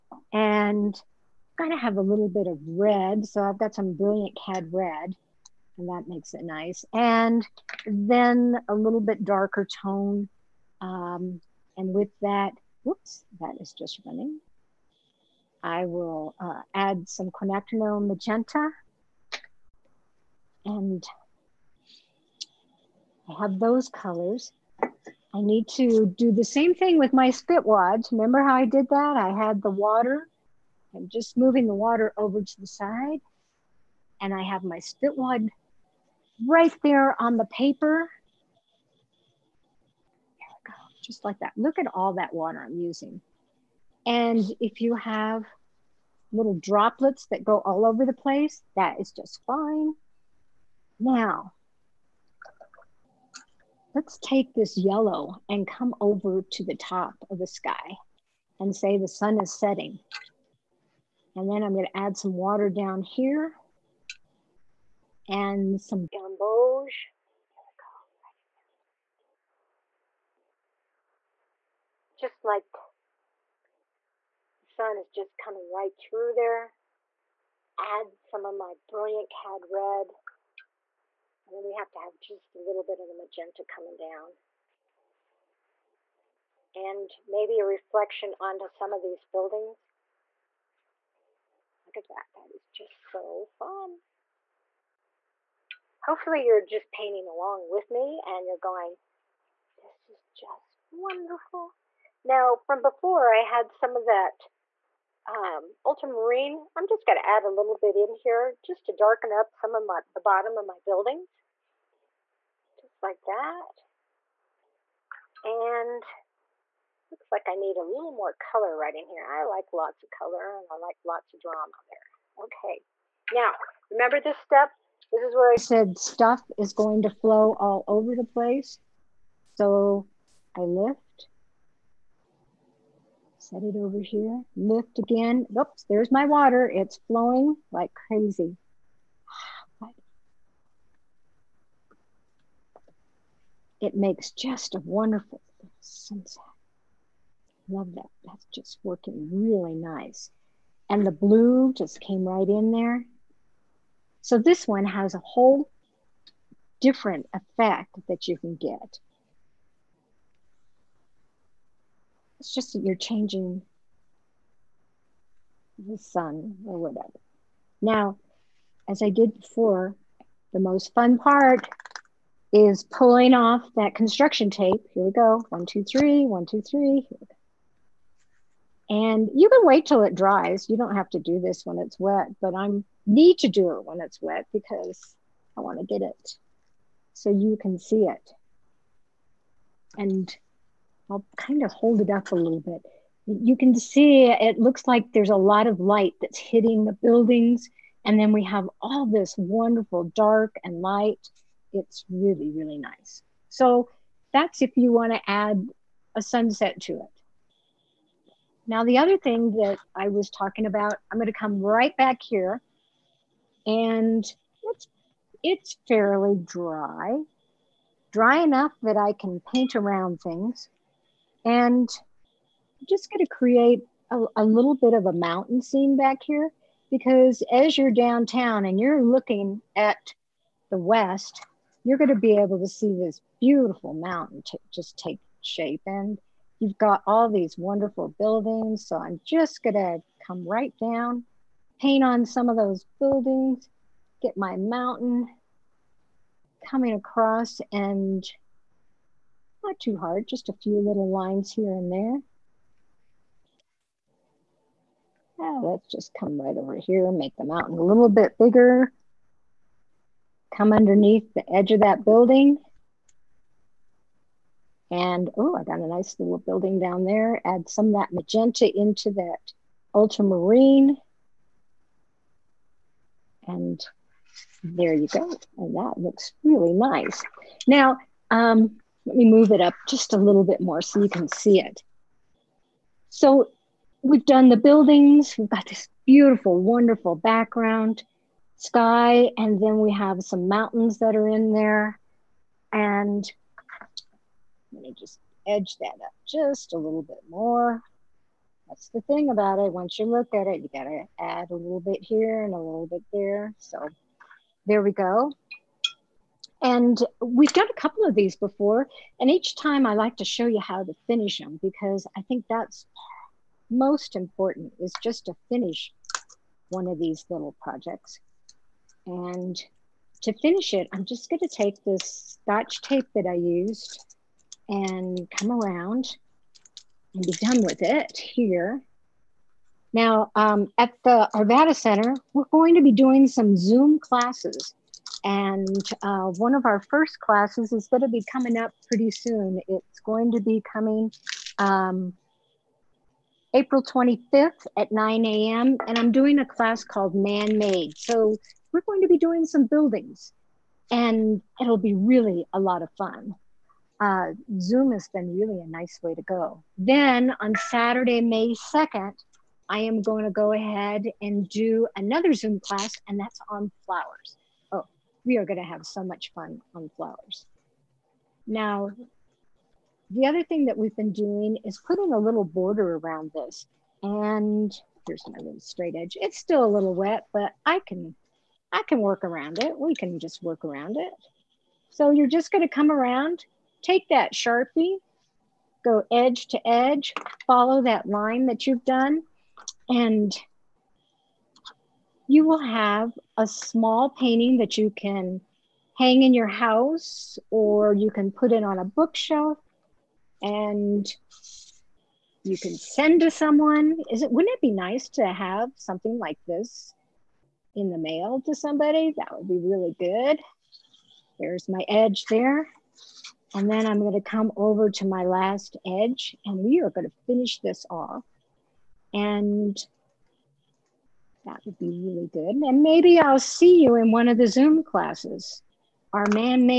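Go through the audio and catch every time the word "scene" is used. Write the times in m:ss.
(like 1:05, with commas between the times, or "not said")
3:45.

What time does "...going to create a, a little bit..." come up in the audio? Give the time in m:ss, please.
3:43.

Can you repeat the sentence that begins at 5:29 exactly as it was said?
Now, um, at the Arvada Center, we're going to be doing some Zoom classes.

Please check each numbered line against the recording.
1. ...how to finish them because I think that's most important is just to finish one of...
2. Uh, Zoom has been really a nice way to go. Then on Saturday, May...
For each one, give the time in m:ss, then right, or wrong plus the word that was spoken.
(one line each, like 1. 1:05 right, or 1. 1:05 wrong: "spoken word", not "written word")
1. 5:10 right
2. 5:53 right.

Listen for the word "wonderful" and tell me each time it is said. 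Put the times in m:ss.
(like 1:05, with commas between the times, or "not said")
1:40, 2:24, 3:19, 3:57, 4:46.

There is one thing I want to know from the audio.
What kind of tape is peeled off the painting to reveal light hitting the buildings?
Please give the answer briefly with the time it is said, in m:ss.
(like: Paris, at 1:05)
Construction tape, at 2:53.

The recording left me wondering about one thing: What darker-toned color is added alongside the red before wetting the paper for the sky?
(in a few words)
Quinacridone magenta.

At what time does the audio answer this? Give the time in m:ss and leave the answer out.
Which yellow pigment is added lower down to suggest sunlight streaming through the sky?
1:06.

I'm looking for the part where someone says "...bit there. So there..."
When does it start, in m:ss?
5:02.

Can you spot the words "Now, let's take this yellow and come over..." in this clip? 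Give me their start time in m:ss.
0:50.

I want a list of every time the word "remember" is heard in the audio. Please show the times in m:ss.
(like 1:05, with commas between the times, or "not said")
0:27, 2:03.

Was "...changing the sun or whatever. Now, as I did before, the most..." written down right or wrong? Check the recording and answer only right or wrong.
right.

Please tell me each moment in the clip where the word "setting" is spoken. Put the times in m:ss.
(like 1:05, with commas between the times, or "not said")
0:59.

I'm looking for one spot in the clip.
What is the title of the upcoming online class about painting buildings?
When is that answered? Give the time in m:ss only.
5:47.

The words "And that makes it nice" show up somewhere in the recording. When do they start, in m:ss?
0:05.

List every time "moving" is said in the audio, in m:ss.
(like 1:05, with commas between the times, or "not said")
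0:31.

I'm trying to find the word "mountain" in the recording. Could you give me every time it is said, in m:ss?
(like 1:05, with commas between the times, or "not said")
3:45, 3:53, 4:04, 4:17, 4:50.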